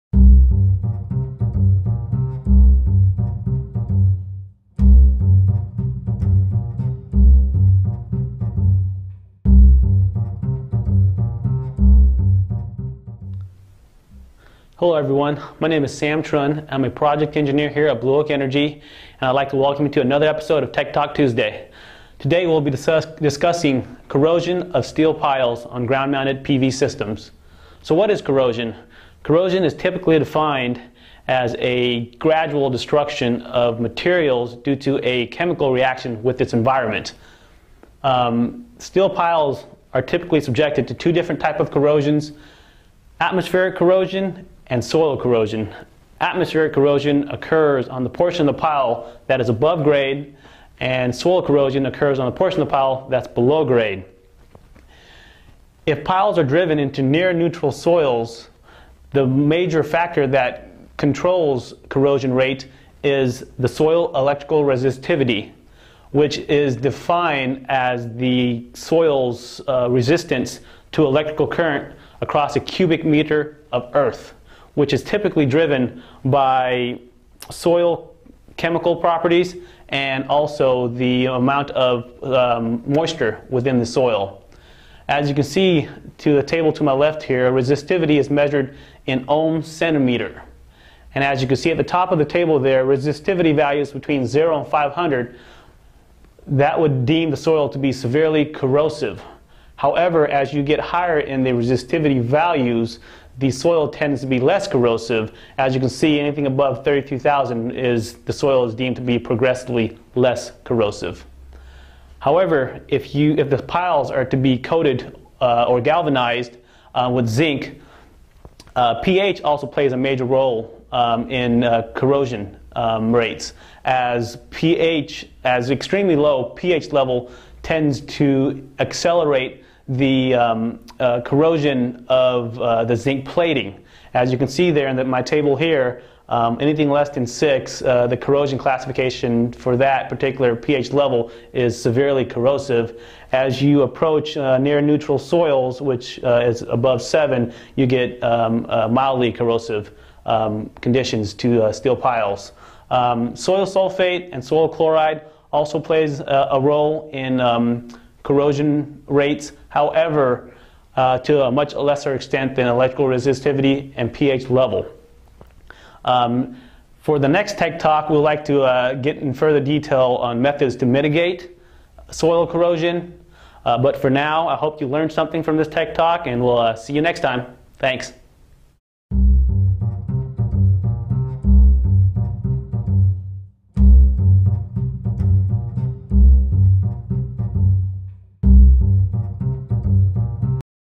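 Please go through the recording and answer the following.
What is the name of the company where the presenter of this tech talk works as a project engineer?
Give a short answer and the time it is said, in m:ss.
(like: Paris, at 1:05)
Blue Oak Energy, at 0:18.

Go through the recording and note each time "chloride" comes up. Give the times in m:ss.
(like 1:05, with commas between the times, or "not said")
2:34.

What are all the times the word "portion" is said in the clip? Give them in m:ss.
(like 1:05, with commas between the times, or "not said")
0:48, 0:52.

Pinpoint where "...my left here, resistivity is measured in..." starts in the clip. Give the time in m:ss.
1:26.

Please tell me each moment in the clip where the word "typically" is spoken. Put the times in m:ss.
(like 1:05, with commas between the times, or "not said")
0:29, 0:40, 1:15.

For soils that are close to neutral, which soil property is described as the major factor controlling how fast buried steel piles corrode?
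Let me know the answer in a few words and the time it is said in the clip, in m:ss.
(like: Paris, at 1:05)
soil electrical resistivity, at 1:03.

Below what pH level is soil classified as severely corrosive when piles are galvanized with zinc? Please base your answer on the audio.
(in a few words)
6.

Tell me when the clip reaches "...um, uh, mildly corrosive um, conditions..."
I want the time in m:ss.
2:28.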